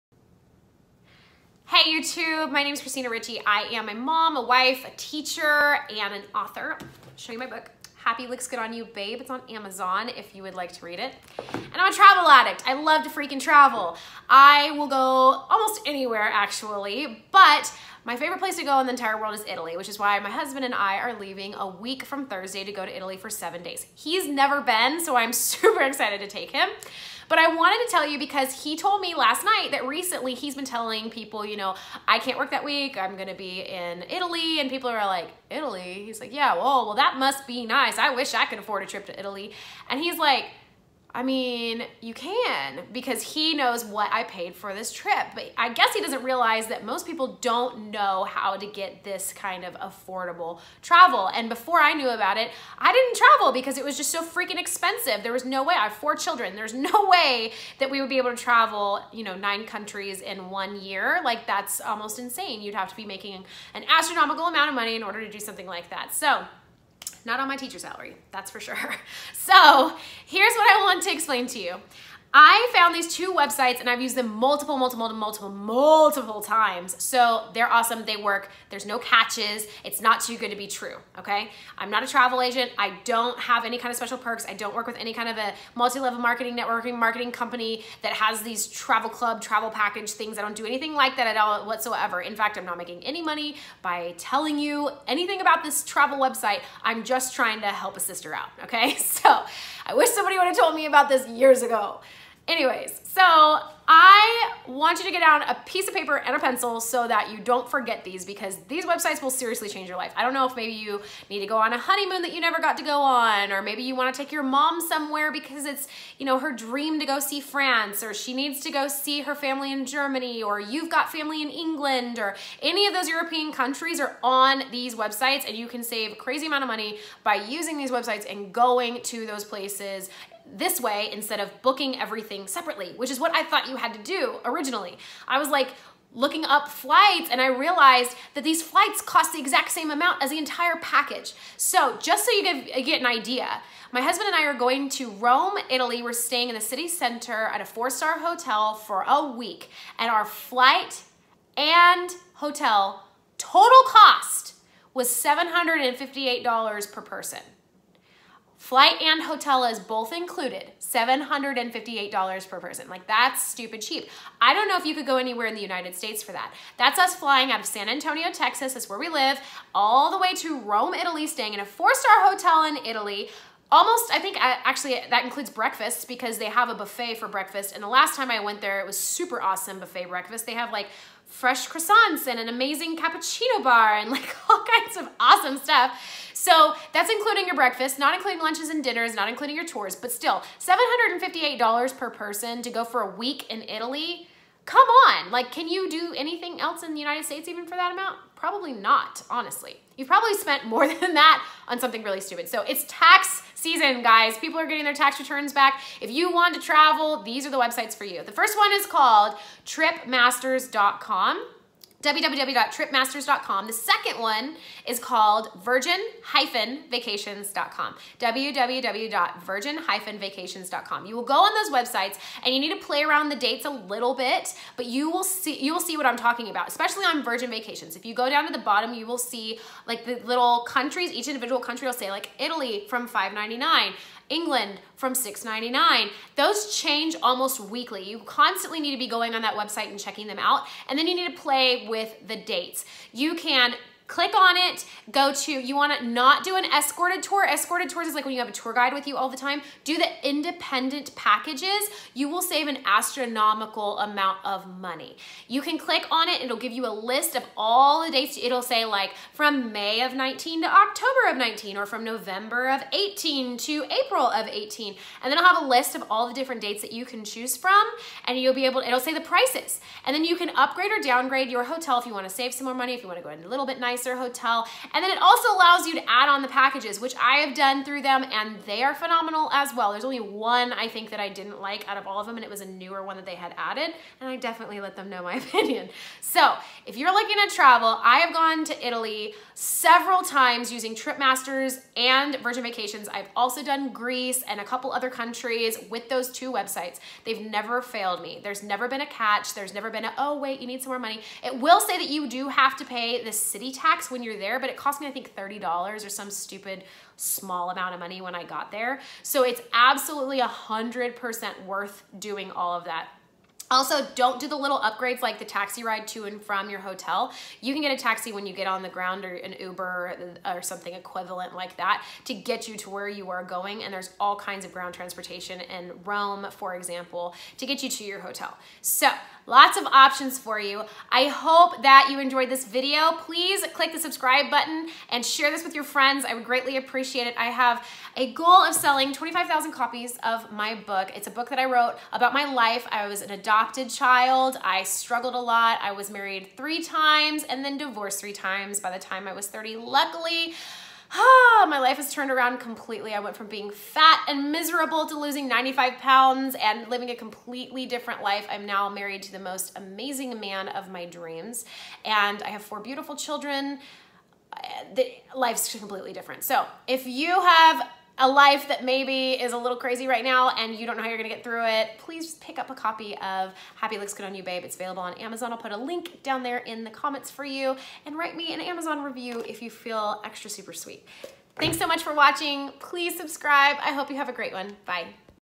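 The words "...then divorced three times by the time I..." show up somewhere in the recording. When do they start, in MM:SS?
05:47.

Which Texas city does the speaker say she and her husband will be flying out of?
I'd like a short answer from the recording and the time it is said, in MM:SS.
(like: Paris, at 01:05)
San Antonio, at 02:47.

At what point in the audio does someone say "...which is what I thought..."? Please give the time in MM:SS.
02:12.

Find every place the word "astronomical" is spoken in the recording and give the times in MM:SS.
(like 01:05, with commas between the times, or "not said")
01:03, 04:12.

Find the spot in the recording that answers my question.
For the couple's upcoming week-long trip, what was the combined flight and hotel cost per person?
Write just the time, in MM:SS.
02:35.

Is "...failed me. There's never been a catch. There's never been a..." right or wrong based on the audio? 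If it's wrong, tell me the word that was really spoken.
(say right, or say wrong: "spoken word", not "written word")
right.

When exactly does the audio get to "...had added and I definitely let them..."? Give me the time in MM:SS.
04:43.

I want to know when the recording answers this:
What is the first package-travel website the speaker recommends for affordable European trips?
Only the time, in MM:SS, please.
03:29.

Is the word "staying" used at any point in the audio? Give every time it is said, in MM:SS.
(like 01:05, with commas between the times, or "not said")
02:26, 02:51.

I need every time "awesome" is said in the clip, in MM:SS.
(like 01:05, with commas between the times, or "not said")
01:17, 02:59, 03:05.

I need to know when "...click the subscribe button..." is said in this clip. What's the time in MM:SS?
05:33.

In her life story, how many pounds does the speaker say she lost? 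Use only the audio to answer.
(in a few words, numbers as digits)
95 pounds.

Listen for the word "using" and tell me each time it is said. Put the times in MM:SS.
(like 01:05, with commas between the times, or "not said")
02:07, 04:50.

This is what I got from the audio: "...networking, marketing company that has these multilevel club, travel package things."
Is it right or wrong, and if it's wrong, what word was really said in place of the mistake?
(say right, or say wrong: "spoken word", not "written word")
wrong: "travel", not "multilevel".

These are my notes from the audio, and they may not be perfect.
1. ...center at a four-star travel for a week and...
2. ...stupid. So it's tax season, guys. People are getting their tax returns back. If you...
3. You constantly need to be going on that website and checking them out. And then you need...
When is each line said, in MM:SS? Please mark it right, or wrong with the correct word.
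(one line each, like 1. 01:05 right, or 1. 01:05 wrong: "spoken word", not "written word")
1. 02:26 wrong: "hotel", not "travel"
2. 03:22 right
3. 03:58 right.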